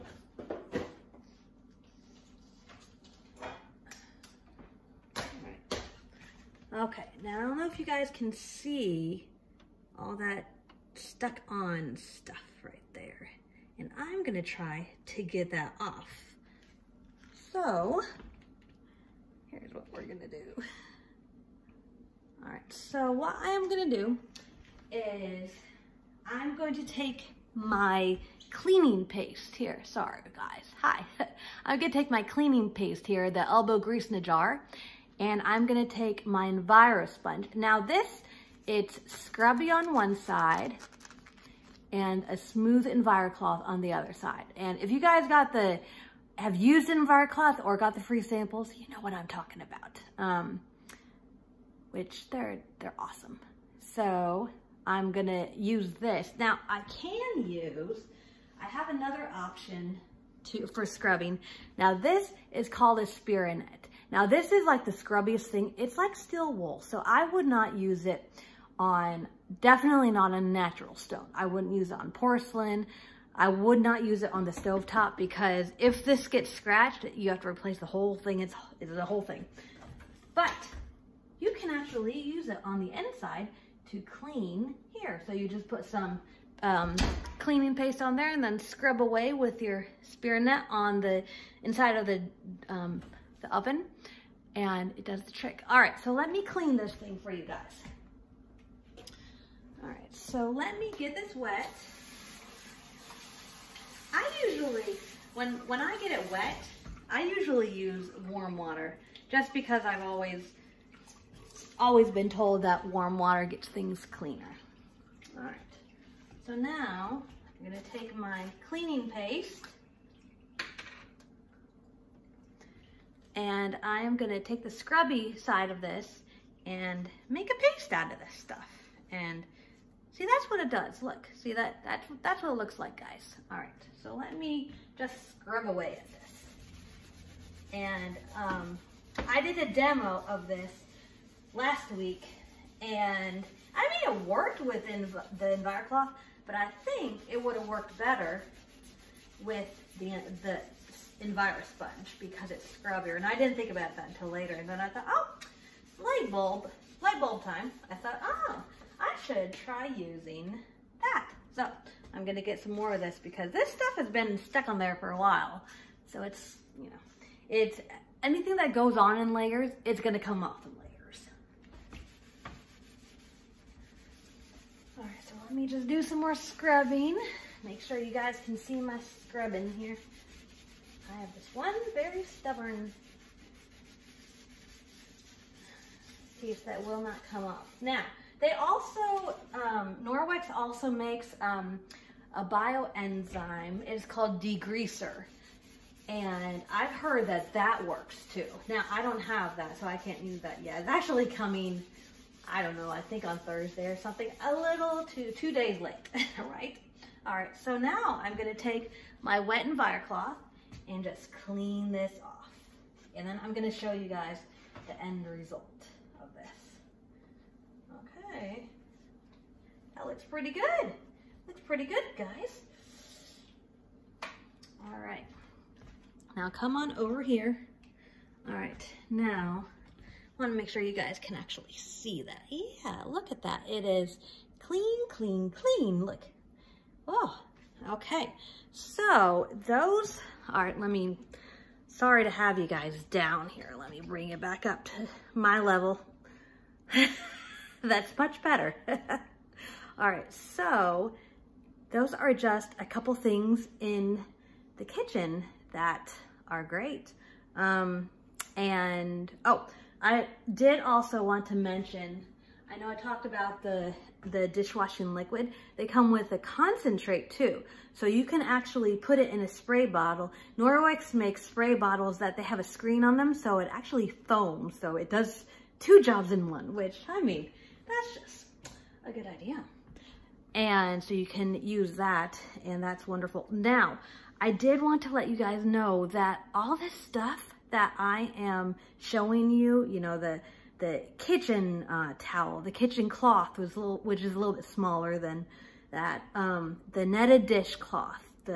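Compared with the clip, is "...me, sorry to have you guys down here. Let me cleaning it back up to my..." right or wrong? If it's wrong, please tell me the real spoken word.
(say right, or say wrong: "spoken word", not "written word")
wrong: "bring", not "cleaning".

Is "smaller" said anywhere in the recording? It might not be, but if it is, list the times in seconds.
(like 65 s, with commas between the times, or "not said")
294 s.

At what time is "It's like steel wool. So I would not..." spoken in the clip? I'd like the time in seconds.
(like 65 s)
65 s.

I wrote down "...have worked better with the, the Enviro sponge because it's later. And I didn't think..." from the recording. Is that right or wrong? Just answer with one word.
wrong.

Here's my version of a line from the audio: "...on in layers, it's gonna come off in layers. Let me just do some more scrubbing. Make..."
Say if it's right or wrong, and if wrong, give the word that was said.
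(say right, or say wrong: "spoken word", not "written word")
right.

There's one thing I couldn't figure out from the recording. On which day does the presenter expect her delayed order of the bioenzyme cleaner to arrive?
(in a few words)
Thursday.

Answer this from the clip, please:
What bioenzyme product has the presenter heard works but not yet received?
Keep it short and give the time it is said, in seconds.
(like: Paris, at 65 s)
degreaser, at 194 s.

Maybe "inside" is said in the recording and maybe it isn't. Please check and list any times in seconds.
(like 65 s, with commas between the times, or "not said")
82 s, 91 s.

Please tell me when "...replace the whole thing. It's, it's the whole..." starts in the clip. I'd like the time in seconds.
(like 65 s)
77 s.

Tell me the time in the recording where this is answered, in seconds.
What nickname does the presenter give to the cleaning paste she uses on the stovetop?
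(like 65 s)
33 s.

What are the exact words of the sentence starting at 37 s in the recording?
Now this, it's scrubby on one side and a smooth Enviro cloth on the other side.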